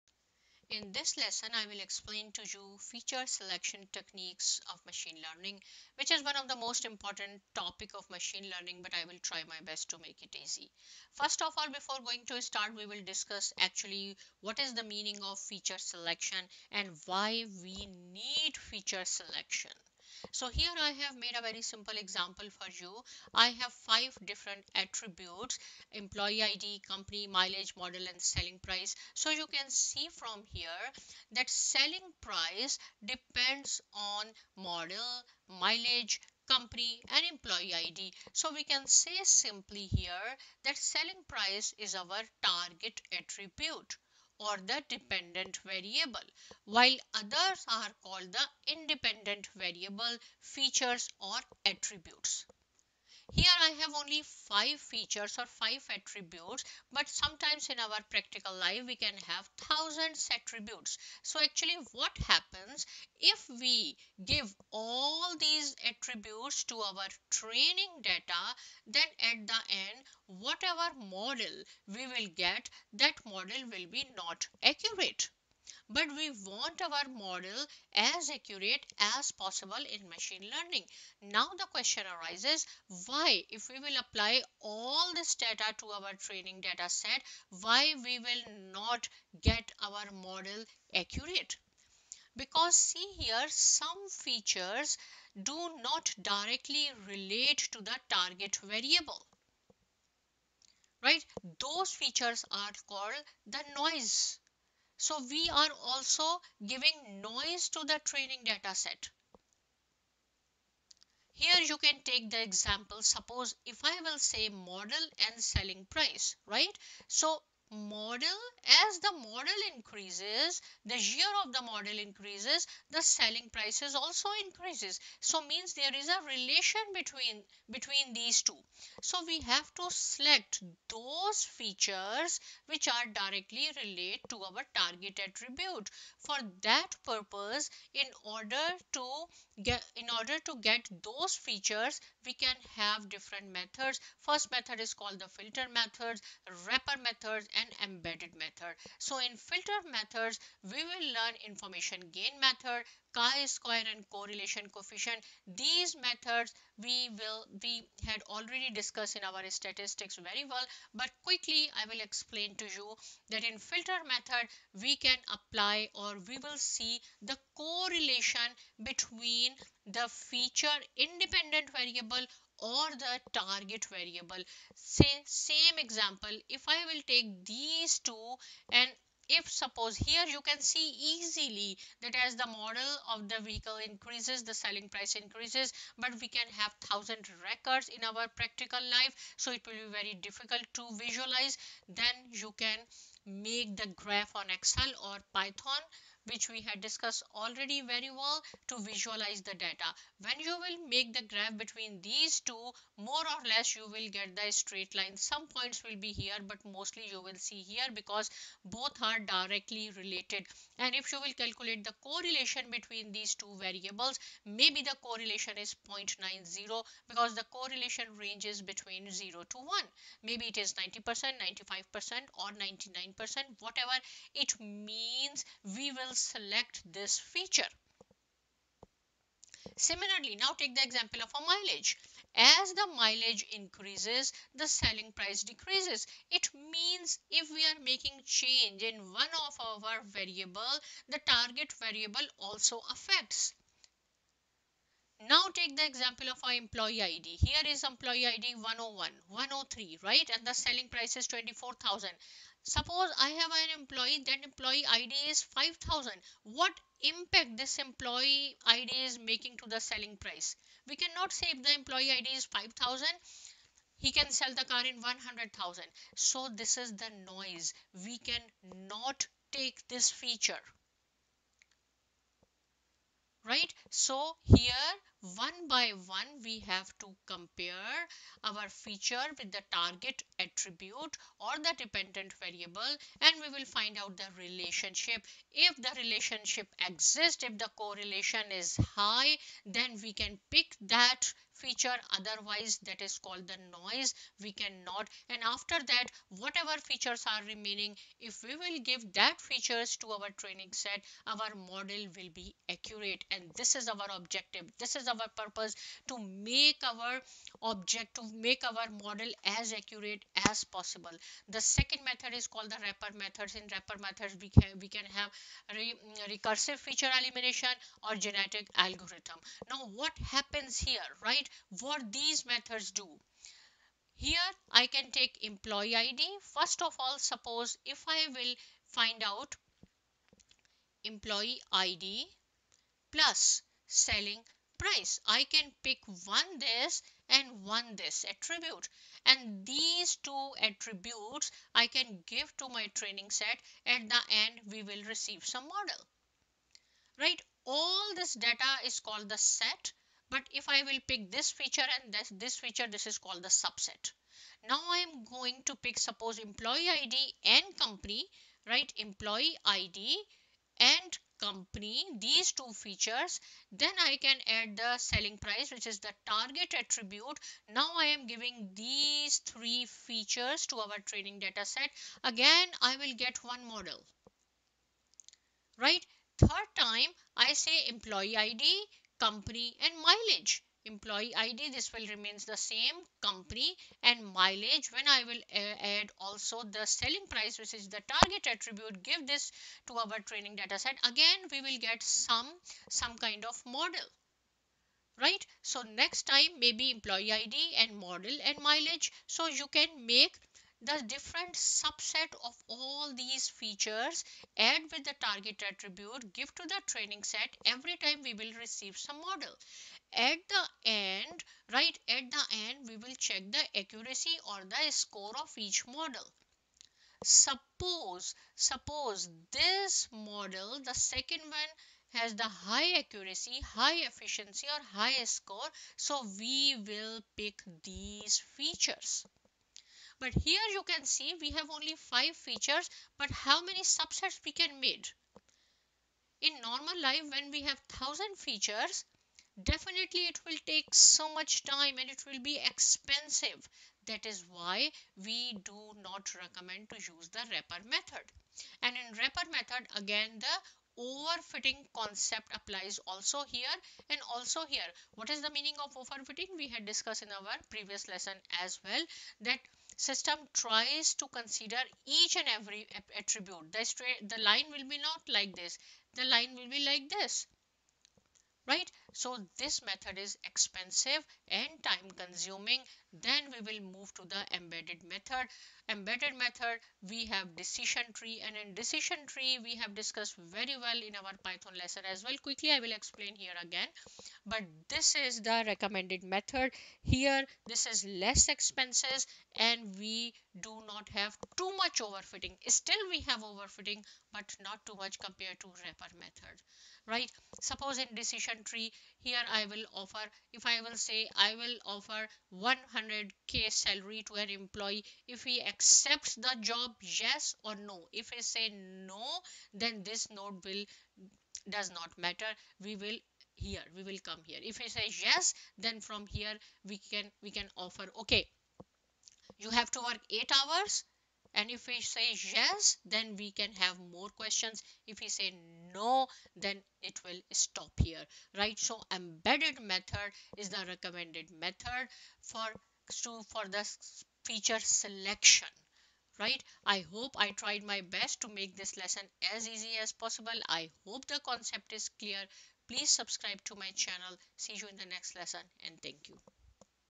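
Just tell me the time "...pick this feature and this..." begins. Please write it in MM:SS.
05:51.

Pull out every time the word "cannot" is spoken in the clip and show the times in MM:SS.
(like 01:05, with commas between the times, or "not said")
04:20, 04:54.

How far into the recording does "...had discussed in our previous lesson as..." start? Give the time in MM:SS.
07:36.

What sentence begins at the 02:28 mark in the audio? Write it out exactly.
So in filter methods, we will learn information gain method, chi-square and correlation coefficient.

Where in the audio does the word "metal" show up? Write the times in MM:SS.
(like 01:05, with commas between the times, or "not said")
not said.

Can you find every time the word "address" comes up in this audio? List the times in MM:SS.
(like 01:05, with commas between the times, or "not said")
not said.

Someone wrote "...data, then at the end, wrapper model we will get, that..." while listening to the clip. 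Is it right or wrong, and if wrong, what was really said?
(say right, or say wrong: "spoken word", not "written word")
wrong: "whatever", not "wrapper".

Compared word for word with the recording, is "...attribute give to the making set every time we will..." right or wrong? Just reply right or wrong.
wrong.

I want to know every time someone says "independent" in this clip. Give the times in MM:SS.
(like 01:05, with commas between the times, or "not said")
00:48, 02:50.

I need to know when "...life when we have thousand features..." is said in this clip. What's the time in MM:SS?
07:17.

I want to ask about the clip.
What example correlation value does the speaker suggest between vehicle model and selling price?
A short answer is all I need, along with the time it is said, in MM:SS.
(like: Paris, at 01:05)
0.90, at 03:35.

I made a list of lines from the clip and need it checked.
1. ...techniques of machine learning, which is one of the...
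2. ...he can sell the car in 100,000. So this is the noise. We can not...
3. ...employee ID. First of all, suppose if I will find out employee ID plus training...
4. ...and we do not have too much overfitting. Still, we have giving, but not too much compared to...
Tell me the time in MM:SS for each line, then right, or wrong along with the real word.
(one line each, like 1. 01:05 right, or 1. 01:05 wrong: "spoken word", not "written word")
1. 00:03 right
2. 04:23 right
3. 05:25 wrong: "selling", not "training"
4. 08:09 wrong: "overfitting", not "giving".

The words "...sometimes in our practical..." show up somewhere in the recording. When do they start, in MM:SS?
00:57.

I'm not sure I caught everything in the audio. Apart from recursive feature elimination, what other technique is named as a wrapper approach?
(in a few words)
Genetic algorithm.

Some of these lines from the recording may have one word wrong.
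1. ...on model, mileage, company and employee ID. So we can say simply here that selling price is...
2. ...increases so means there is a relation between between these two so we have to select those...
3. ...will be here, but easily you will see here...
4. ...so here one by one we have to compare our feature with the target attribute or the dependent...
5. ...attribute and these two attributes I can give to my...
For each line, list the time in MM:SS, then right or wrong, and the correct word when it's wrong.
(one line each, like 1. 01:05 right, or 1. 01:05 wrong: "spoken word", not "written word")
1. 00:33 right
2. 02:04 right
3. 03:25 wrong: "mostly", not "easily"
4. 04:33 right
5. 05:38 right.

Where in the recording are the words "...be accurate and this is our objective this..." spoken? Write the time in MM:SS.
05:02.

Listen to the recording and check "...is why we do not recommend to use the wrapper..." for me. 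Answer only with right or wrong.
right.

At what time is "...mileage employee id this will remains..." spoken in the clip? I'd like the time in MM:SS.
06:20.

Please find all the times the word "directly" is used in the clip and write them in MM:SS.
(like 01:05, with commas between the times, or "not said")
01:36, 02:13, 03:29.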